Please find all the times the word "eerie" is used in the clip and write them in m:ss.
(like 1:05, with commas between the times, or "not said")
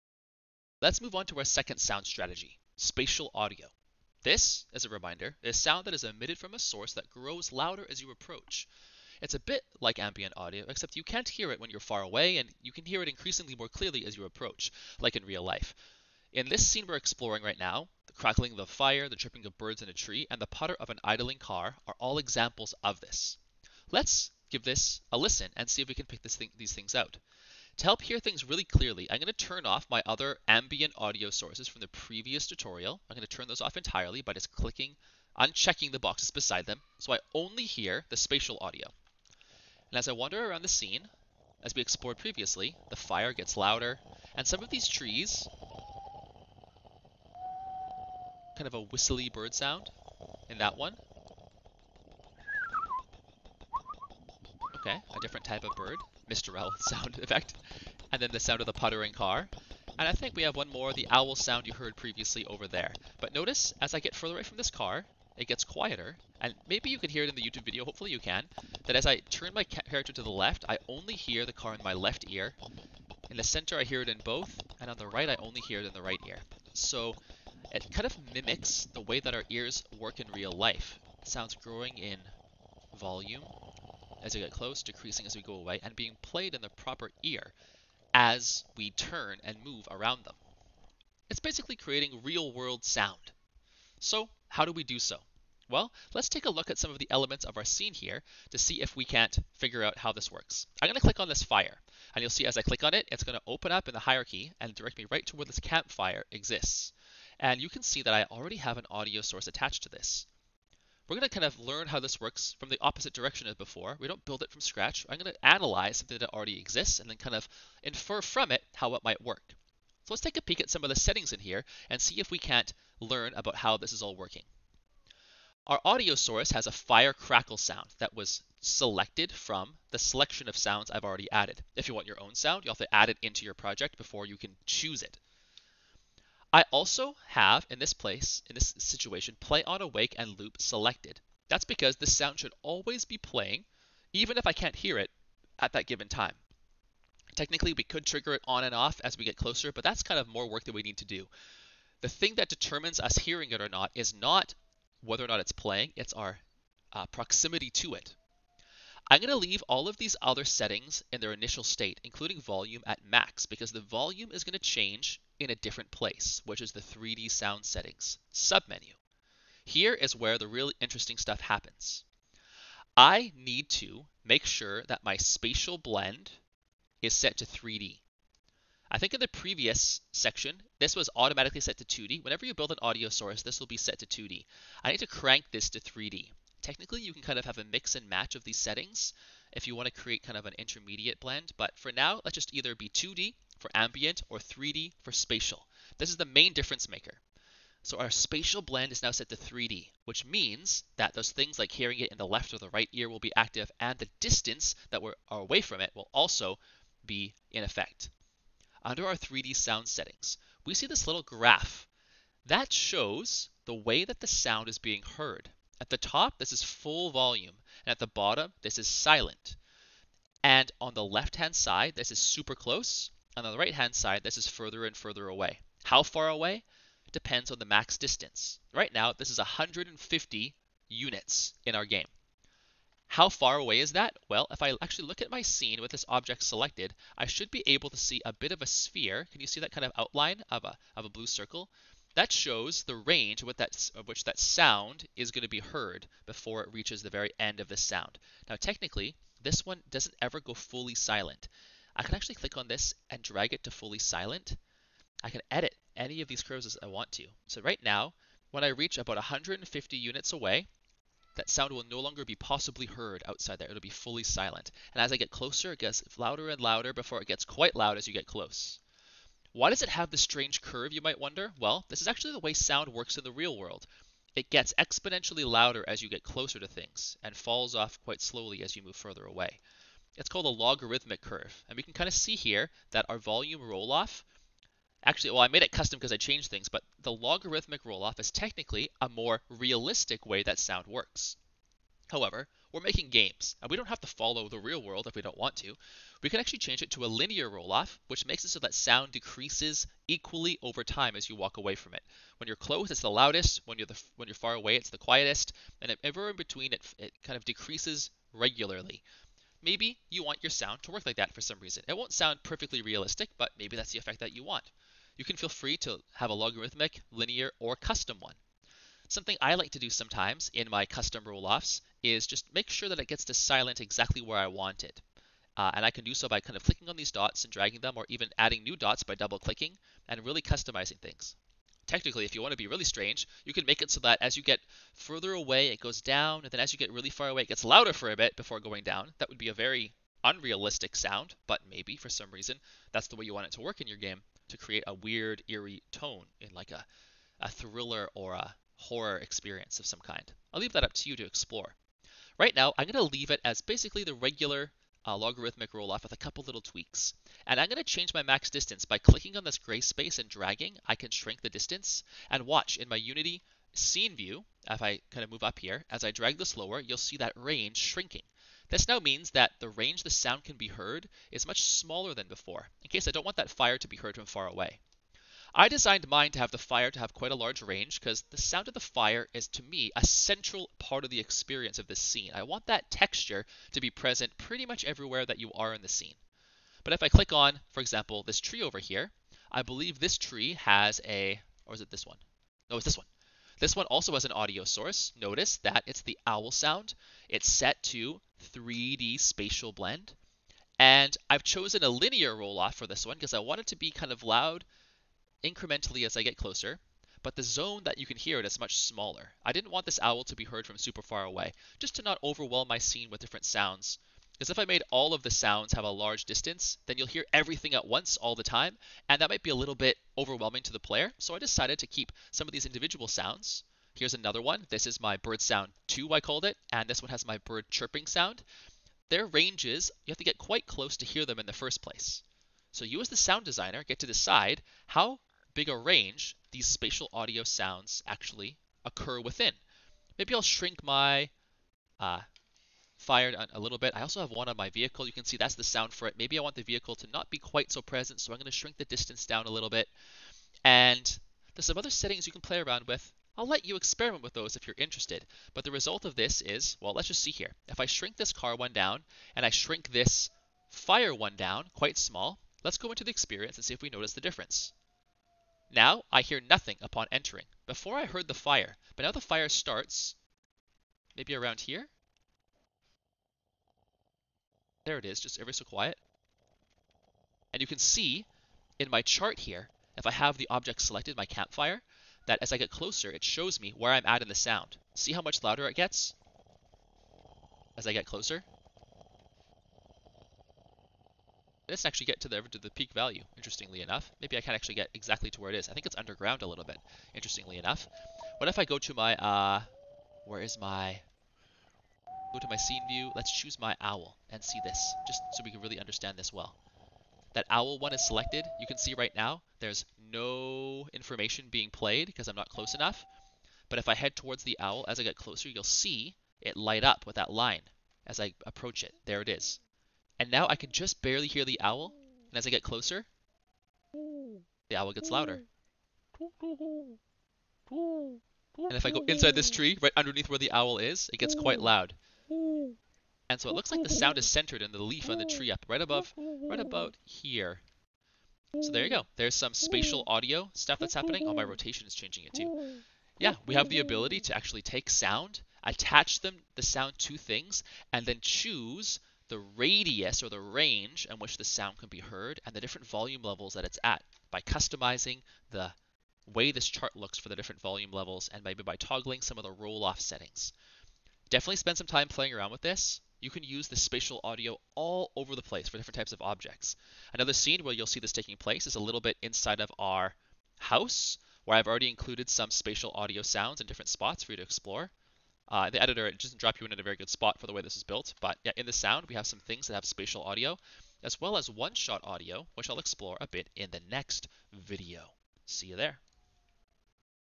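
5:45.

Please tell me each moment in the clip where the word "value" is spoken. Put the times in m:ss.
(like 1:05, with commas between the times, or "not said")
8:12.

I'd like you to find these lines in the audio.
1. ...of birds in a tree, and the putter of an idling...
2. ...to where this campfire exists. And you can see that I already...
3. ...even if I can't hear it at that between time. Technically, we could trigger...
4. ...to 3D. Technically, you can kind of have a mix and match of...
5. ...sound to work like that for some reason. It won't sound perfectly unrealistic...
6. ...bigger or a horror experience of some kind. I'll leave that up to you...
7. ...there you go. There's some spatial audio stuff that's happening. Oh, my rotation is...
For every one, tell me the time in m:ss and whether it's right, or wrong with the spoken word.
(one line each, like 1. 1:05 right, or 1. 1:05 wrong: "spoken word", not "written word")
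1. 0:19 right
2. 1:45 right
3. 2:24 wrong: "given", not "between"
4. 3:05 right
5. 5:10 wrong: "realistic", not "unrealistic"
6. 5:47 wrong: "thriller", not "bigger"
7. 8:58 right.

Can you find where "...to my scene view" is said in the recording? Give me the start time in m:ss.
8:22.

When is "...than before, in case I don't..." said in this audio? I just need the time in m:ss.
6:12.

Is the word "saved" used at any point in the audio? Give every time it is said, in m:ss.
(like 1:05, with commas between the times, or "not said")
not said.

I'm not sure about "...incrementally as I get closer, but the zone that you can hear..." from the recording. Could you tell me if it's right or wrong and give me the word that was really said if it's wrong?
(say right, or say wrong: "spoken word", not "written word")
right.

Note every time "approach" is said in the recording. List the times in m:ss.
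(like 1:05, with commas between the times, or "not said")
0:08, 0:14, 8:38.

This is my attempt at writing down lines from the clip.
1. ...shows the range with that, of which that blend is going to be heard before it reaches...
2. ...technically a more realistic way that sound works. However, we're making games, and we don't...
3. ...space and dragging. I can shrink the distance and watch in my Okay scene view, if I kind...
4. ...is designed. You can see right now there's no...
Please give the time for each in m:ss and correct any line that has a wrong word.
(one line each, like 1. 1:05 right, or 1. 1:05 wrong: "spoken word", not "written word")
1. 4:02 wrong: "sound", not "blend"
2. 4:48 right
3. 5:59 wrong: "Unity", not "Okay"
4. 8:27 wrong: "selected", not "designed".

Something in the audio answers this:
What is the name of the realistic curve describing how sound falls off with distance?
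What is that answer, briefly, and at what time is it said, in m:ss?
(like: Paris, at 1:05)
logarithmic curve, at 4:40.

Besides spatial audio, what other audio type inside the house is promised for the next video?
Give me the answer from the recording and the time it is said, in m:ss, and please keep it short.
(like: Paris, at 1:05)
one-shot audio, at 9:41.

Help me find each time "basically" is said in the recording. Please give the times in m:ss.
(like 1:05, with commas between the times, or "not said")
1:31, 5:53.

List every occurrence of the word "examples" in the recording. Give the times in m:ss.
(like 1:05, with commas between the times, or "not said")
0:22, 6:27.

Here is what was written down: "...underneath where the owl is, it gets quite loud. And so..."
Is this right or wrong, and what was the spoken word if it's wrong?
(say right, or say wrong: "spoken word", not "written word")
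right.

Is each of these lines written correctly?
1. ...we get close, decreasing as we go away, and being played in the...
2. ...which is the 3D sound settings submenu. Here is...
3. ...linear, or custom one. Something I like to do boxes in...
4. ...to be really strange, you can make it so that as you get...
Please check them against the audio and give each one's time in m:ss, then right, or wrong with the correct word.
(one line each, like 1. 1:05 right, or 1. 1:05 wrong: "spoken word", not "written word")
1. 1:24 right
2. 2:46 right
3. 5:17 wrong: "sometimes", not "boxes"
4. 5:32 right.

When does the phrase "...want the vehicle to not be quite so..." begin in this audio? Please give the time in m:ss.
7:26.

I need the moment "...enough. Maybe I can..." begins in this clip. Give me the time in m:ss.
8:13.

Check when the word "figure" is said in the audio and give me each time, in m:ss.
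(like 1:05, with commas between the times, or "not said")
1:39.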